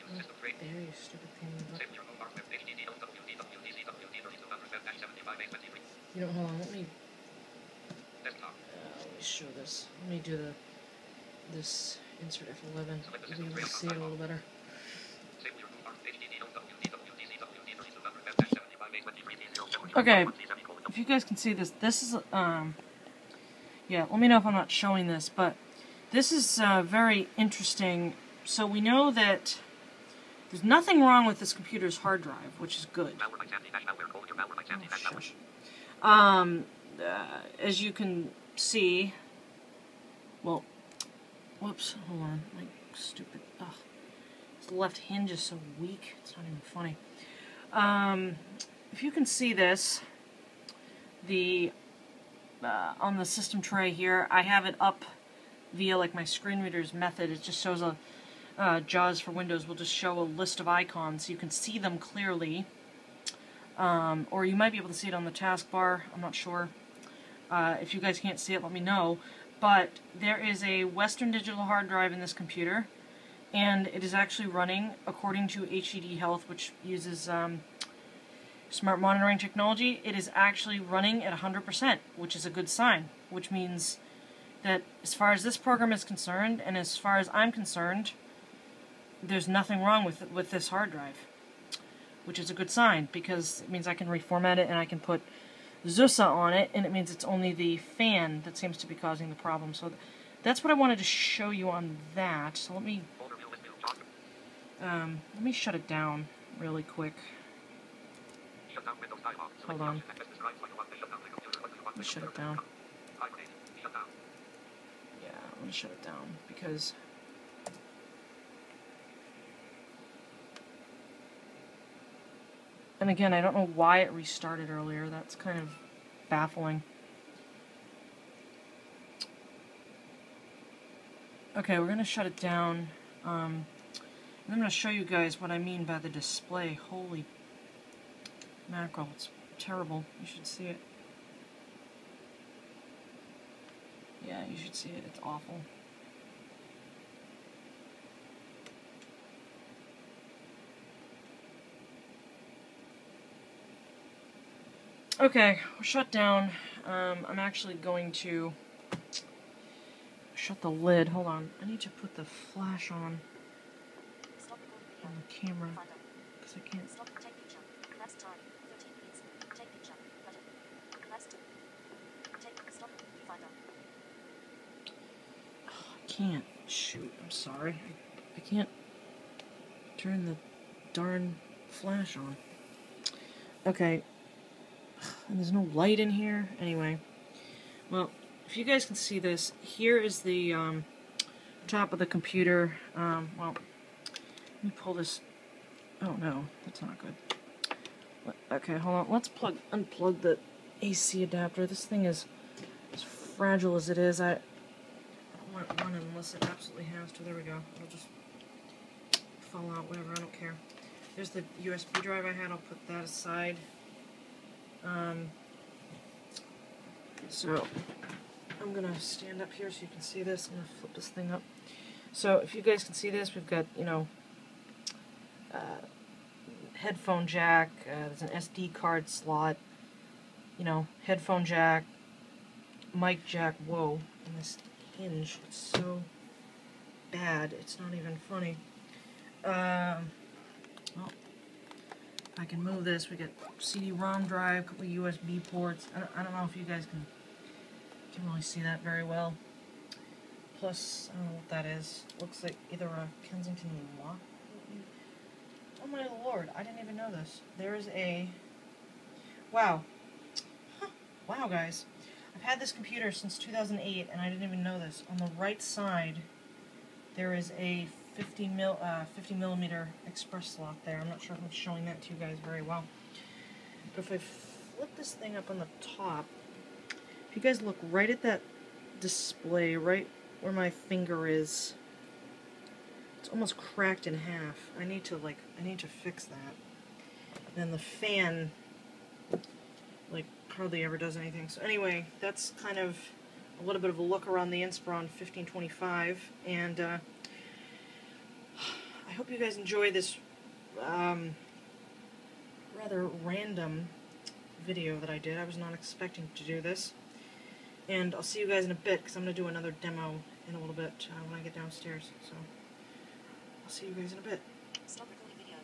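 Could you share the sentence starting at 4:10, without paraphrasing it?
Plus, I don't know what that is.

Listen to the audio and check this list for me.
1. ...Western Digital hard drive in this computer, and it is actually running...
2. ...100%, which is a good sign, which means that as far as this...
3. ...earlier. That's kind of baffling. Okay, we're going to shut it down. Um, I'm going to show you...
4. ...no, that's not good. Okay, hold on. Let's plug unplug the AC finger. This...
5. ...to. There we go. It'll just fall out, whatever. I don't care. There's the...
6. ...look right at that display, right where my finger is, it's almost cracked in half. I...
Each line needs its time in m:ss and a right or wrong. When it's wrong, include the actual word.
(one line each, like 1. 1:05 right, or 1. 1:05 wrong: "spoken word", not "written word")
1. 1:10 right
2. 1:21 right
3. 2:04 right
4. 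3:16 wrong: "adapter", not "finger"
5. 3:27 right
6. 4:37 right.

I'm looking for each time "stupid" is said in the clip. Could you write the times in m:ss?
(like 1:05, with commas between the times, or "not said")
0:00, 0:42.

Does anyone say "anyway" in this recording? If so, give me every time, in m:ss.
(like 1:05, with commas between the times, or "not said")
3:06, 4:51.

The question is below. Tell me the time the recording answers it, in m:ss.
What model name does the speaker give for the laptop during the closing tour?
4:54.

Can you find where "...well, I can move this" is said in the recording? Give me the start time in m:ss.
4:00.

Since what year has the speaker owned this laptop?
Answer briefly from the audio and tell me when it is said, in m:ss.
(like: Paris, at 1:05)
2008, at 4:23.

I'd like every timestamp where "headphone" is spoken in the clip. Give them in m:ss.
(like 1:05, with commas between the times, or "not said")
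3:46, 3:51.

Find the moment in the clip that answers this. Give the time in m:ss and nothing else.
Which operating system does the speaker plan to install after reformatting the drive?
1:35.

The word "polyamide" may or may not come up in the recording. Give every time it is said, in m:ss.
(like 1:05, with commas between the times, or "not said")
not said.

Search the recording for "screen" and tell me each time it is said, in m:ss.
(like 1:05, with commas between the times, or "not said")
0:56.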